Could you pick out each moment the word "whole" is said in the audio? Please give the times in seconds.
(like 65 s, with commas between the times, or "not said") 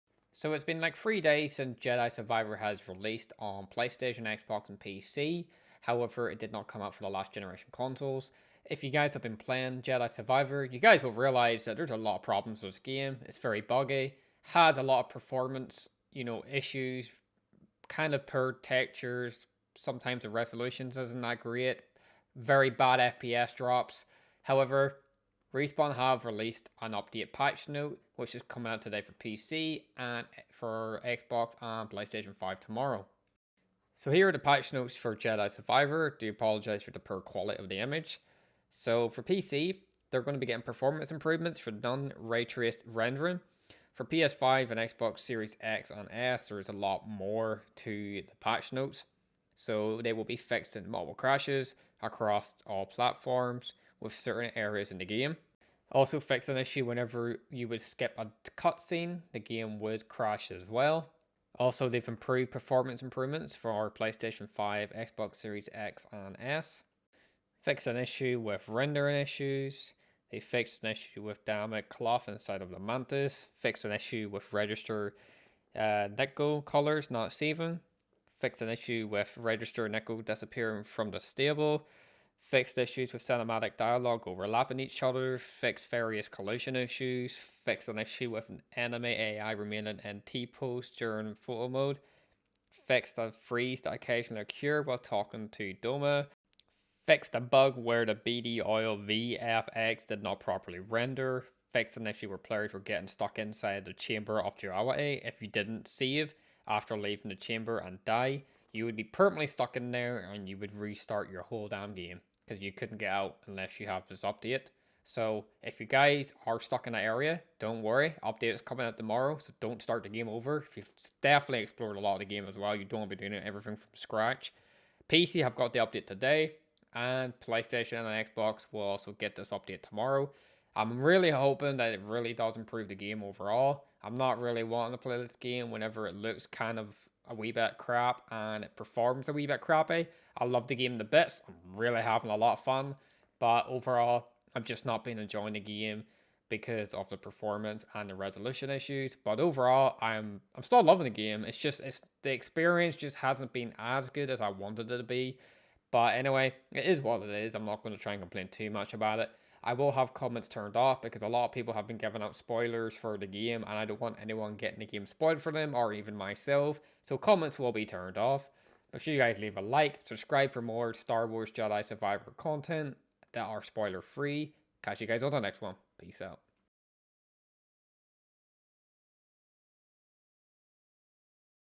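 111 s.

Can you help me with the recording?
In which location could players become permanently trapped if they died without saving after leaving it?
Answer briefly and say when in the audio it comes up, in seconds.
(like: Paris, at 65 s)
Chamber of Duality, at 103 s.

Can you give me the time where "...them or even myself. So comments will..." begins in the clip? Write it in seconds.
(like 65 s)
165 s.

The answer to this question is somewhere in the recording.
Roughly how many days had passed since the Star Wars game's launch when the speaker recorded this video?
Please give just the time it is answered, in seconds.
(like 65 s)
0 s.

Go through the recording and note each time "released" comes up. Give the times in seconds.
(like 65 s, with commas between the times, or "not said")
2 s, 26 s.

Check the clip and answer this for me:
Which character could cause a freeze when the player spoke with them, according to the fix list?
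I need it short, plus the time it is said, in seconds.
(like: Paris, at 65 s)
Doma, at 95 s.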